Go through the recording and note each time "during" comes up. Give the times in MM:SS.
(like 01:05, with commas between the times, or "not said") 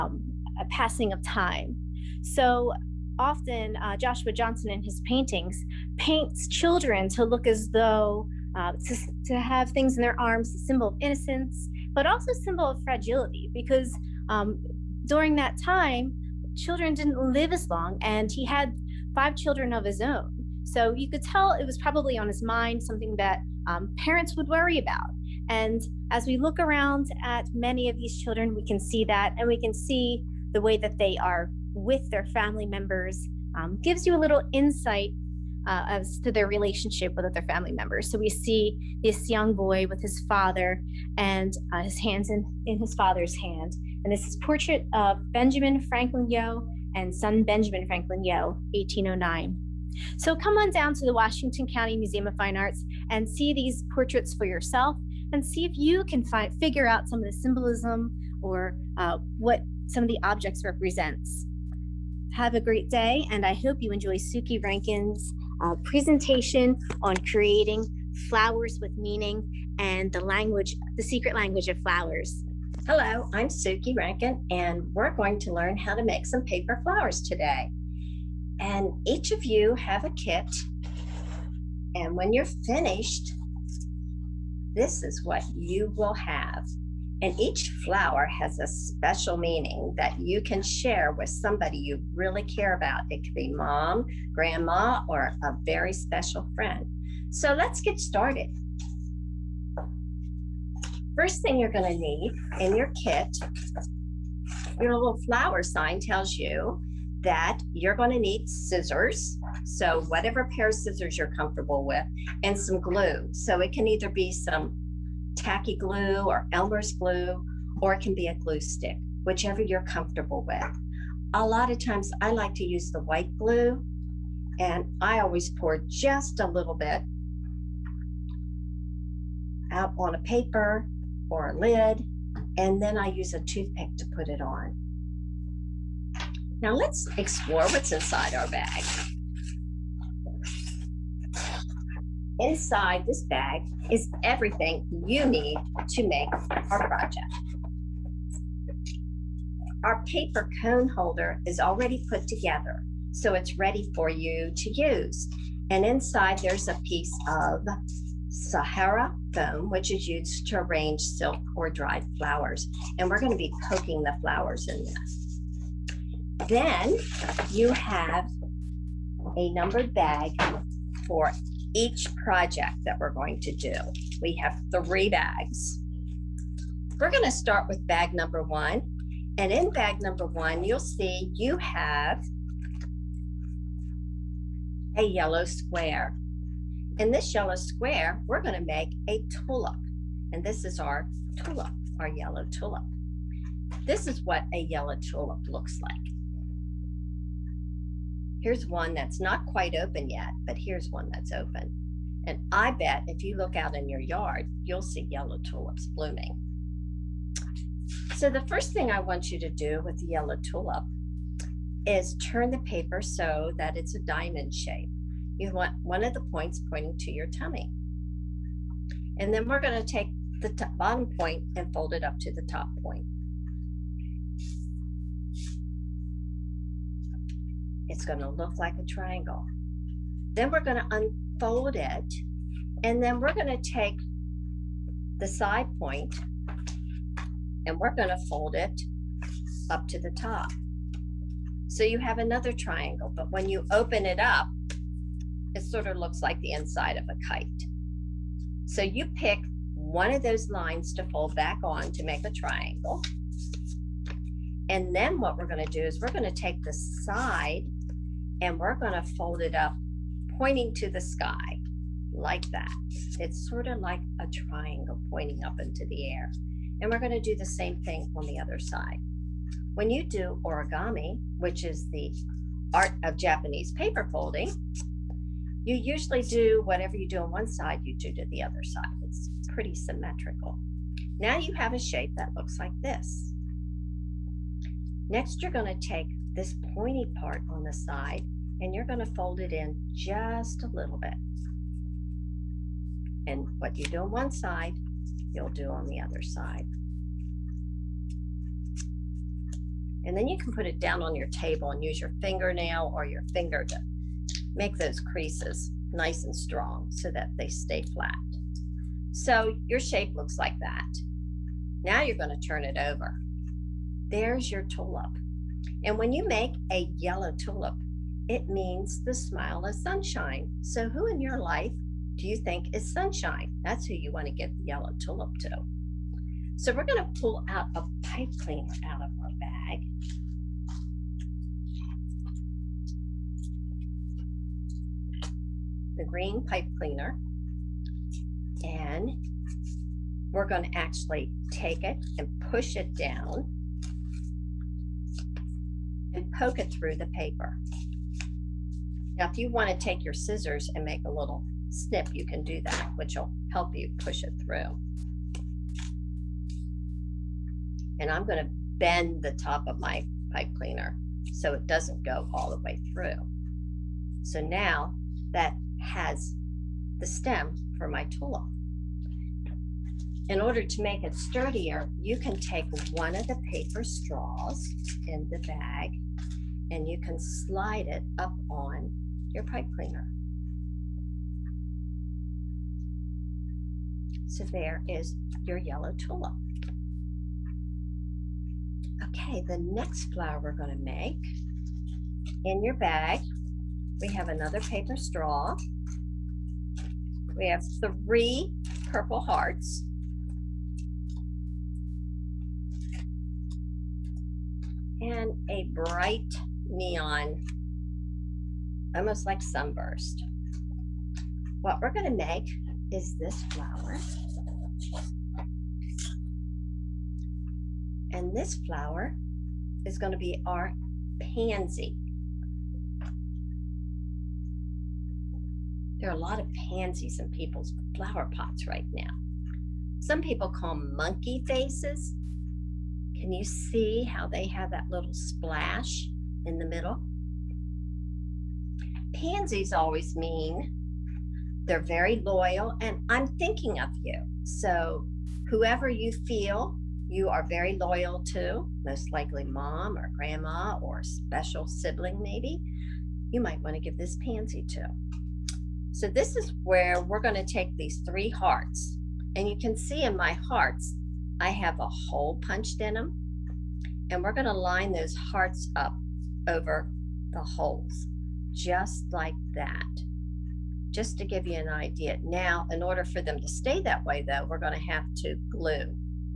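00:15.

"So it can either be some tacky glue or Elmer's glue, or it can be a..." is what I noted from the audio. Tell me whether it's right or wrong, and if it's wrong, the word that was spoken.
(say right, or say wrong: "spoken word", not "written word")
right.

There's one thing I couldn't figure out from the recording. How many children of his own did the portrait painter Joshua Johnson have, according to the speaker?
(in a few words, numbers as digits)
5.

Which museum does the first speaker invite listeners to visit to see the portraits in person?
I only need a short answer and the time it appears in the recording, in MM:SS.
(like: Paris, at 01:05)
Washington County Museum of Fine Arts, at 00:51.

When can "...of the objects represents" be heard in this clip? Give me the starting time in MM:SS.
01:00.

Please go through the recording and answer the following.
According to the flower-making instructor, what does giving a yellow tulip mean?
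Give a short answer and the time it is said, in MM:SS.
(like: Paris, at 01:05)
the smile of sunshine, at 05:19.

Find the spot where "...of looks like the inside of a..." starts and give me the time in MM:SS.
04:05.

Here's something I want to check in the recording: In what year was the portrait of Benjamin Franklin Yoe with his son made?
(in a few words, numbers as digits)
1809.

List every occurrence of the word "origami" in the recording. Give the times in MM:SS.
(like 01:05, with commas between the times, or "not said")
04:30.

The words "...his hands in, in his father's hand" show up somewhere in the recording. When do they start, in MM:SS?
00:41.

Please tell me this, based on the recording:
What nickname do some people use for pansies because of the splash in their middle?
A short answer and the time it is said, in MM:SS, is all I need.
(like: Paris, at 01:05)
monkey faces, at 07:10.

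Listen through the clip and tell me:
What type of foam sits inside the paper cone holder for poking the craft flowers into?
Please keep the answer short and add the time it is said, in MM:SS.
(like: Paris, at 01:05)
Sahara foam, at 02:38.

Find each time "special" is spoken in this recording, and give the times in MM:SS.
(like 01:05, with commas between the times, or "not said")
01:28, 01:35, 07:31.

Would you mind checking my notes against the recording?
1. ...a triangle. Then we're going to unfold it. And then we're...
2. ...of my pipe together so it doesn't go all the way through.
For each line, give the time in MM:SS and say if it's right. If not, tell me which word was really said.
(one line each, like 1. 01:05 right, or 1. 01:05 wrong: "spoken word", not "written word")
1. 03:48 right
2. 05:59 wrong: "cleaner", not "together".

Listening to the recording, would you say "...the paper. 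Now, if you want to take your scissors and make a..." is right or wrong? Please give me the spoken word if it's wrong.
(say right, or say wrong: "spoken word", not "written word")
right.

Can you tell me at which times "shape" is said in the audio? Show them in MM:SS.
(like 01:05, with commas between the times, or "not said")
03:34, 04:41, 05:09.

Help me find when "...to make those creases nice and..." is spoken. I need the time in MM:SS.
05:03.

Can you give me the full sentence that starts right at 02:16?
Now let's explore what's inside our bag.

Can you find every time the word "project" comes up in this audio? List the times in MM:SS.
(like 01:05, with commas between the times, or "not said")
02:26, 02:52.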